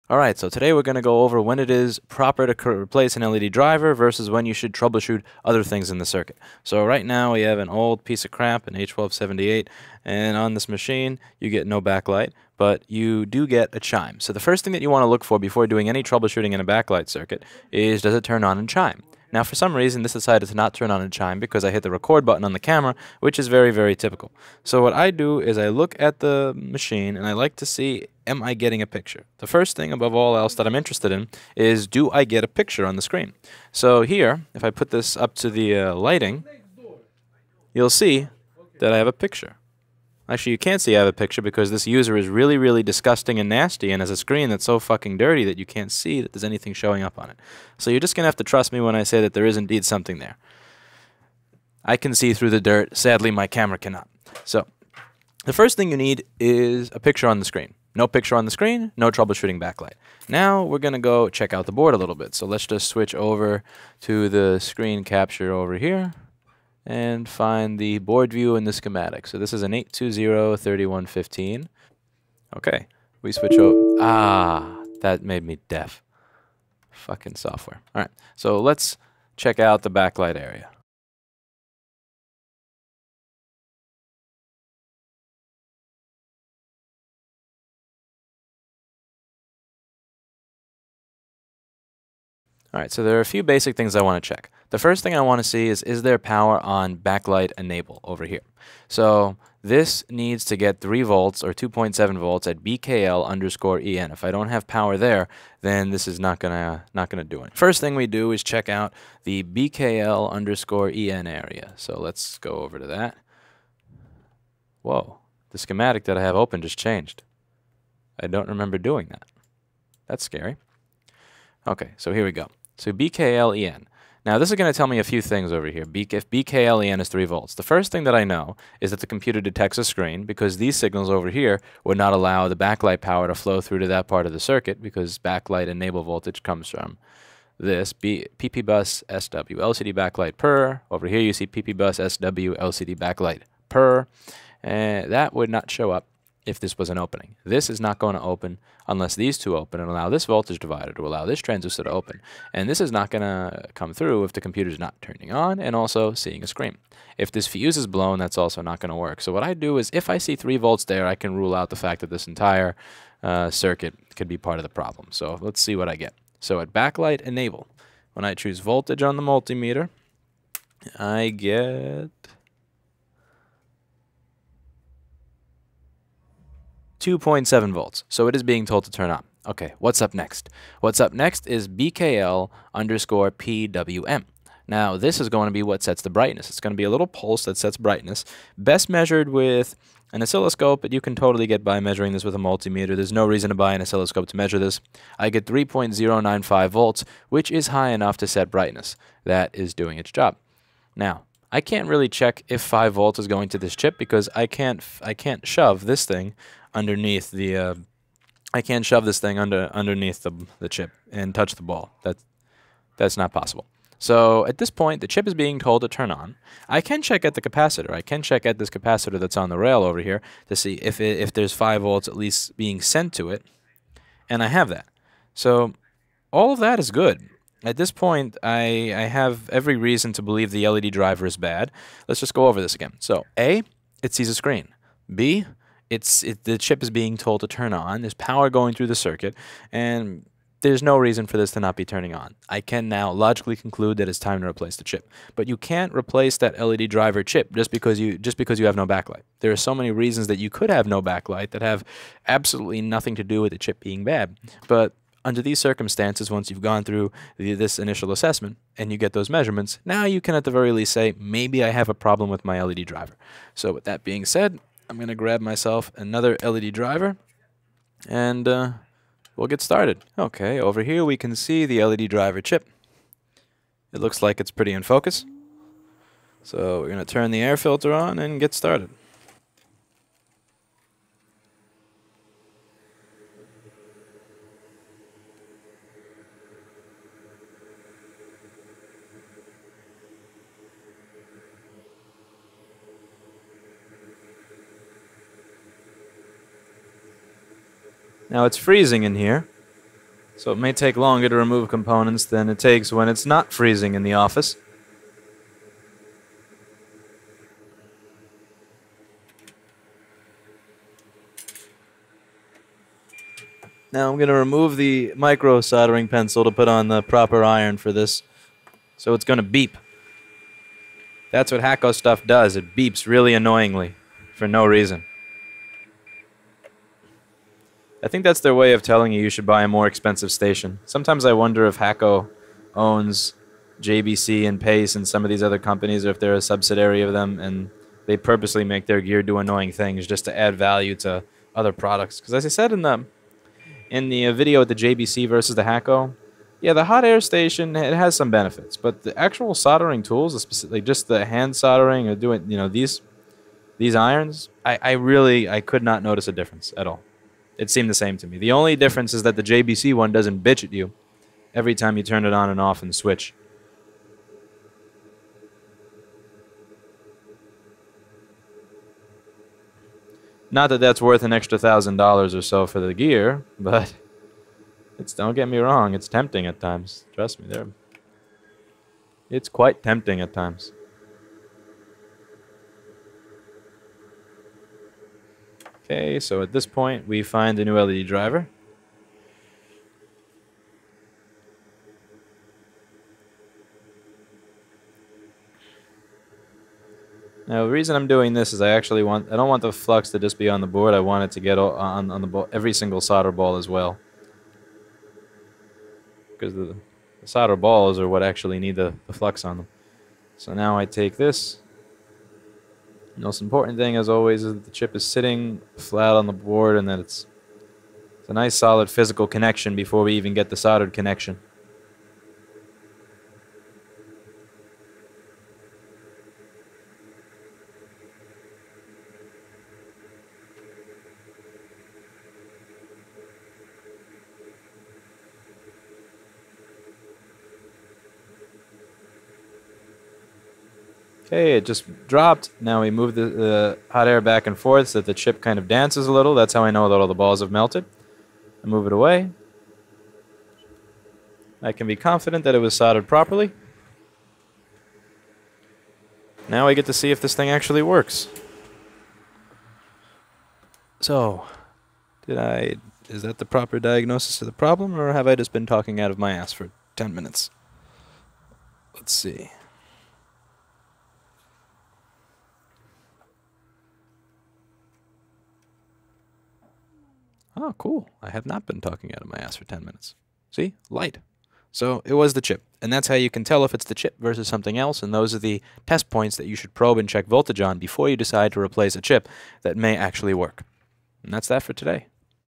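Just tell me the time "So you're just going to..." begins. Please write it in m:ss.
0:47.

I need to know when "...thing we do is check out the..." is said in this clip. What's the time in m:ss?
1:47.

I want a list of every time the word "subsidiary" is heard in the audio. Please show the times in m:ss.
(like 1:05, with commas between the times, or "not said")
5:36.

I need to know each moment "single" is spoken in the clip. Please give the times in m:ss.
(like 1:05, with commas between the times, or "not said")
6:42.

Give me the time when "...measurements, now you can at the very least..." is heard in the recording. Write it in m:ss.
4:19.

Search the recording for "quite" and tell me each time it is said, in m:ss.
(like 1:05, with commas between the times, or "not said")
6:19.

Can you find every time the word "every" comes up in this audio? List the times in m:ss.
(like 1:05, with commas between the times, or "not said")
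3:49, 6:01, 6:42.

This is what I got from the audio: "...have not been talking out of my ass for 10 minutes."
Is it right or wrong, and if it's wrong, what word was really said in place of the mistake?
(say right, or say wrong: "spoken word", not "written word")
right.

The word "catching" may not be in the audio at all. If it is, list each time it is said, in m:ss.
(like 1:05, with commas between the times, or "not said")
not said.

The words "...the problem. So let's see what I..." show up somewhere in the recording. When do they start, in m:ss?
2:44.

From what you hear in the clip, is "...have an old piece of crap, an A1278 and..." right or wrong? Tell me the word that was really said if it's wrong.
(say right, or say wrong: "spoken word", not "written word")
right.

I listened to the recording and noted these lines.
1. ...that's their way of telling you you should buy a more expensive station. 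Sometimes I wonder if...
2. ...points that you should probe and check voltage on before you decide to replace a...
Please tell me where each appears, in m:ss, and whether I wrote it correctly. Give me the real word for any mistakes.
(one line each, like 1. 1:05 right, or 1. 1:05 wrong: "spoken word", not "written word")
1. 5:28 right
2. 8:06 right.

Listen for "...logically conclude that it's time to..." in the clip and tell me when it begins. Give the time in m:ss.
4:03.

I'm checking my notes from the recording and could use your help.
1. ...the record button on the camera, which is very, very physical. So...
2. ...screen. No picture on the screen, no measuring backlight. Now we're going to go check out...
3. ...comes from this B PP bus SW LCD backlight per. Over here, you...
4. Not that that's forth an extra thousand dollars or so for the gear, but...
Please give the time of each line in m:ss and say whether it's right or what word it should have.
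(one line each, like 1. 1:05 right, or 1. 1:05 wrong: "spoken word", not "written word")
1. 0:21 wrong: "typical", not "physical"
2. 0:57 wrong: "troubleshooting", not "measuring"
3. 2:16 right
4. 6:10 wrong: "worth", not "forth".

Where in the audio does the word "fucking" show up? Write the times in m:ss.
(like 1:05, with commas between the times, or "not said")
0:44, 1:16.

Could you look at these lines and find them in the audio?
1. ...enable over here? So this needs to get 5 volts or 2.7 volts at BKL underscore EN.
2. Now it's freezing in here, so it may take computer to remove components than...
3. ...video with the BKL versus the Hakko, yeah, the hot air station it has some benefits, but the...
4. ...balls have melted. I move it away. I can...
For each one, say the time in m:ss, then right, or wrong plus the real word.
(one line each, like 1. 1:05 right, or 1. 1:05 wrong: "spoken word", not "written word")
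1. 1:37 wrong: "3", not "5"
2. 4:58 wrong: "longer", not "computer"
3. 5:44 wrong: "JBC", not "BKL"
4. 7:27 right.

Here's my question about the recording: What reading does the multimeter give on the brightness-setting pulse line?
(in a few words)
3.095 volts.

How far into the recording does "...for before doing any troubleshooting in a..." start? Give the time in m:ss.
0:15.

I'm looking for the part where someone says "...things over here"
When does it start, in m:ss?
2:05.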